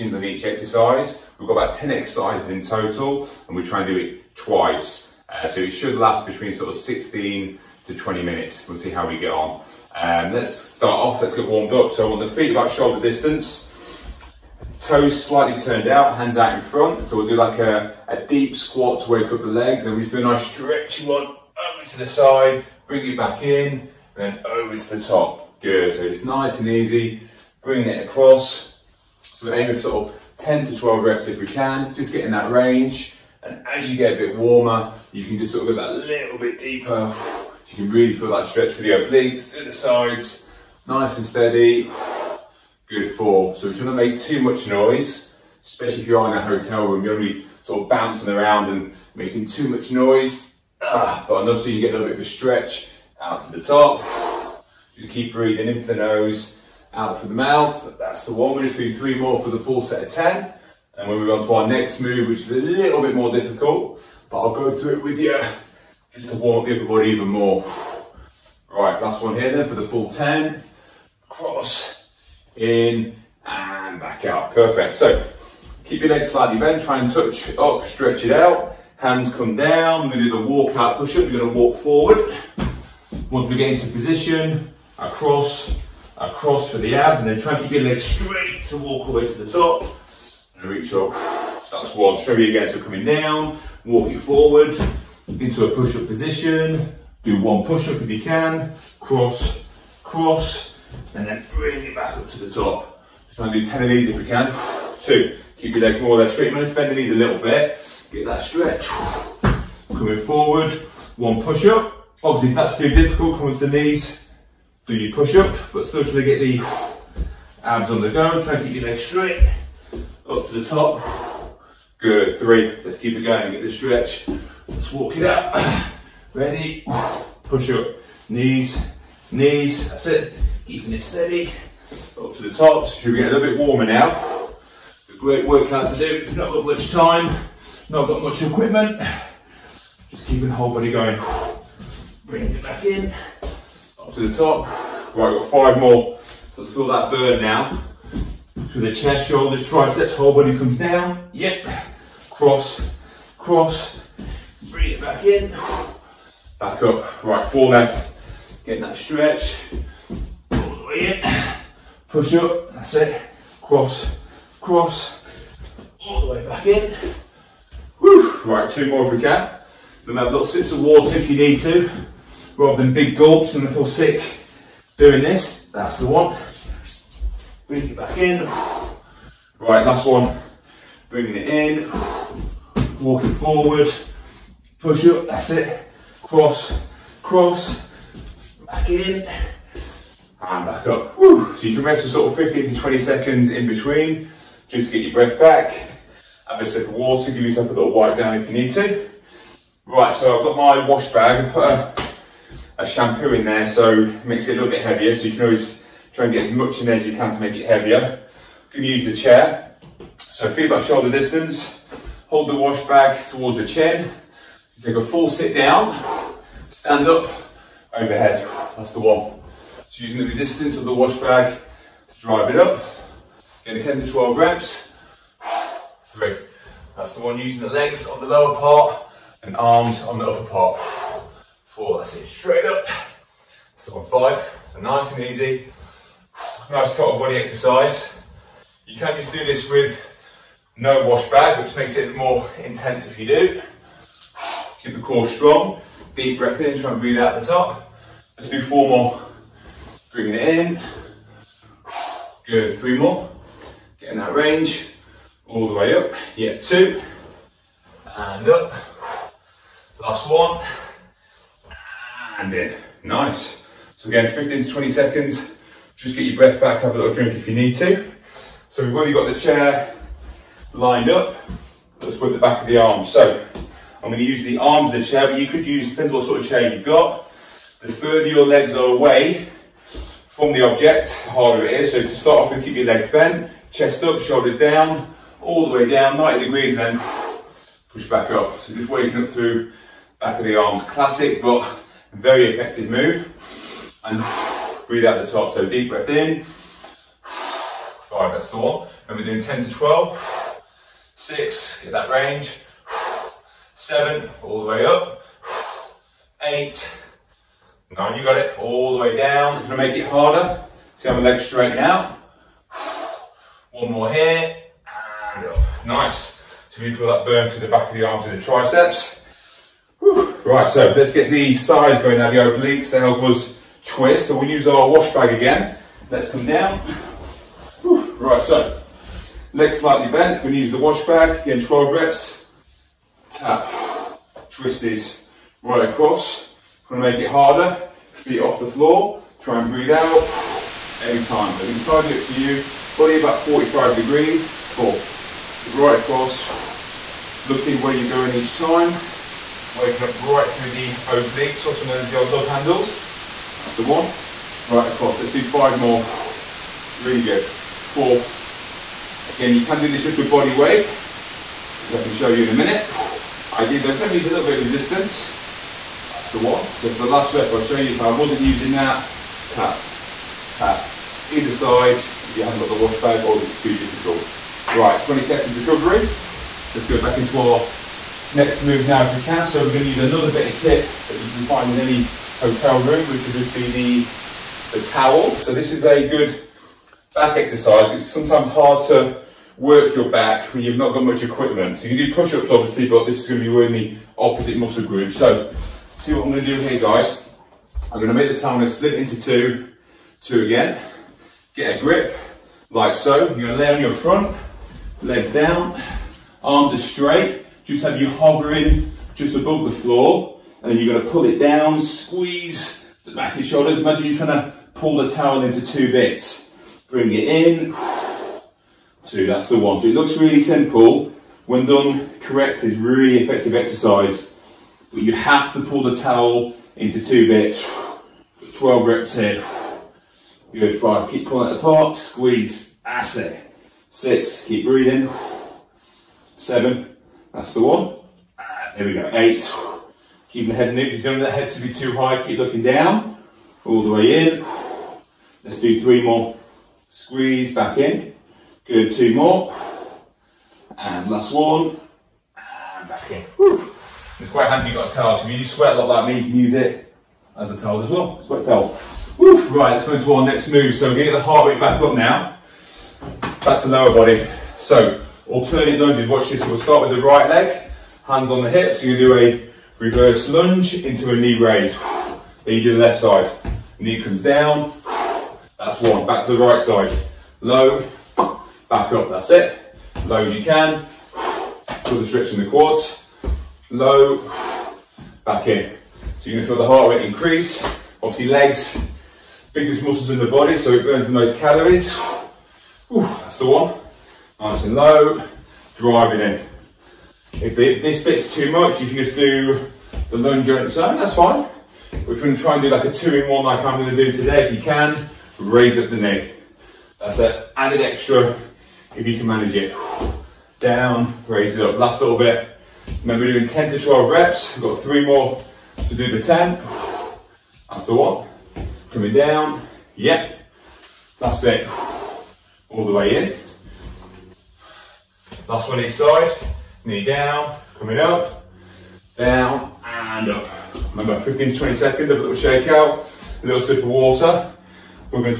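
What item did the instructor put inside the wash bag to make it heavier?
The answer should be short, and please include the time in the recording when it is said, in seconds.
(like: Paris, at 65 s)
Shampoo, at 202 s.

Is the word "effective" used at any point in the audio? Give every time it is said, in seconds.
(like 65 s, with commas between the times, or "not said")
292 s, 423 s.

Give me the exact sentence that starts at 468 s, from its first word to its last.
You're gonna do a reverse lunge into a knee raise.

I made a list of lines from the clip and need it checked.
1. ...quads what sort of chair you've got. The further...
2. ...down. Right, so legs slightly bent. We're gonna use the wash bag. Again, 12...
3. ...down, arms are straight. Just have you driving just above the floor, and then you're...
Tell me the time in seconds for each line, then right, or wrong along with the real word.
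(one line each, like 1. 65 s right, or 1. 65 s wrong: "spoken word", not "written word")
1. 275 s wrong: "depends", not "quads"
2. 326 s right
3. 405 s wrong: "hovering", not "driving".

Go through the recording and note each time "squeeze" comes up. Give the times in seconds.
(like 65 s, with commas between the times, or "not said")
411 s, 431 s, 446 s.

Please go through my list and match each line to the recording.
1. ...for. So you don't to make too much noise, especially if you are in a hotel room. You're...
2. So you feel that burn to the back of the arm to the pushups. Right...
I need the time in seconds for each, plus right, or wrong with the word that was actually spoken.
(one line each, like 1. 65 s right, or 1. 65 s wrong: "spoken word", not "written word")
1. 43 s right
2. 316 s wrong: "triceps", not "pushups".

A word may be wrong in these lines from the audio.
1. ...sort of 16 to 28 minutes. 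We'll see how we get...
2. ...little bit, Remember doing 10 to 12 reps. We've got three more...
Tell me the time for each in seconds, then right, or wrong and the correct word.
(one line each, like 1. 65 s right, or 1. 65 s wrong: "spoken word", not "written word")
1. 6 s wrong: "20", not "28"
2. 512 s right.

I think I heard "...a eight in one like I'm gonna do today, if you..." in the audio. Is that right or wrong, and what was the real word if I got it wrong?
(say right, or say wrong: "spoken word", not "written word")
wrong: "two", not "eight".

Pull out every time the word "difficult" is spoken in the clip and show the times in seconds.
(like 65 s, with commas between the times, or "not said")
63 s, 112 s, 373 s.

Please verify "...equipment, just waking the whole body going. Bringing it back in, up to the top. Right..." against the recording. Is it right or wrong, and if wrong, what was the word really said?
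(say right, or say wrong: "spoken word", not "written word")
wrong: "keeping", not "waking".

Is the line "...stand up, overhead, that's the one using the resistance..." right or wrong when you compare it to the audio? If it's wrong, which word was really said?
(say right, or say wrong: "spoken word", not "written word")
right.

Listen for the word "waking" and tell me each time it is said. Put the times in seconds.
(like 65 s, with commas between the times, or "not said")
288 s, 349 s.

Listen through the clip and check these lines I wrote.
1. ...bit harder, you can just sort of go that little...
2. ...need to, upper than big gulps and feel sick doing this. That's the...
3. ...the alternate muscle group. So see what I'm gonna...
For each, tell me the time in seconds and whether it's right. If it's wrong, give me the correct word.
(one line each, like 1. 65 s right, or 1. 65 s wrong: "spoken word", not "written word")
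1. 34 s wrong: "warmer", not "harder"
2. 171 s wrong: "rather", not "upper"
3. 393 s wrong: "opposite", not "alternate".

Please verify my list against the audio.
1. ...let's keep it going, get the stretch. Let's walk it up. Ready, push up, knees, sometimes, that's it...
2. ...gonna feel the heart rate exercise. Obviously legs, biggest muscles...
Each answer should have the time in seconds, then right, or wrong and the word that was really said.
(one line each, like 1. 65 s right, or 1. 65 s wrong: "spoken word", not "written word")
1. 122 s wrong: "knees", not "sometimes"
2. 486 s wrong: "increase", not "exercise".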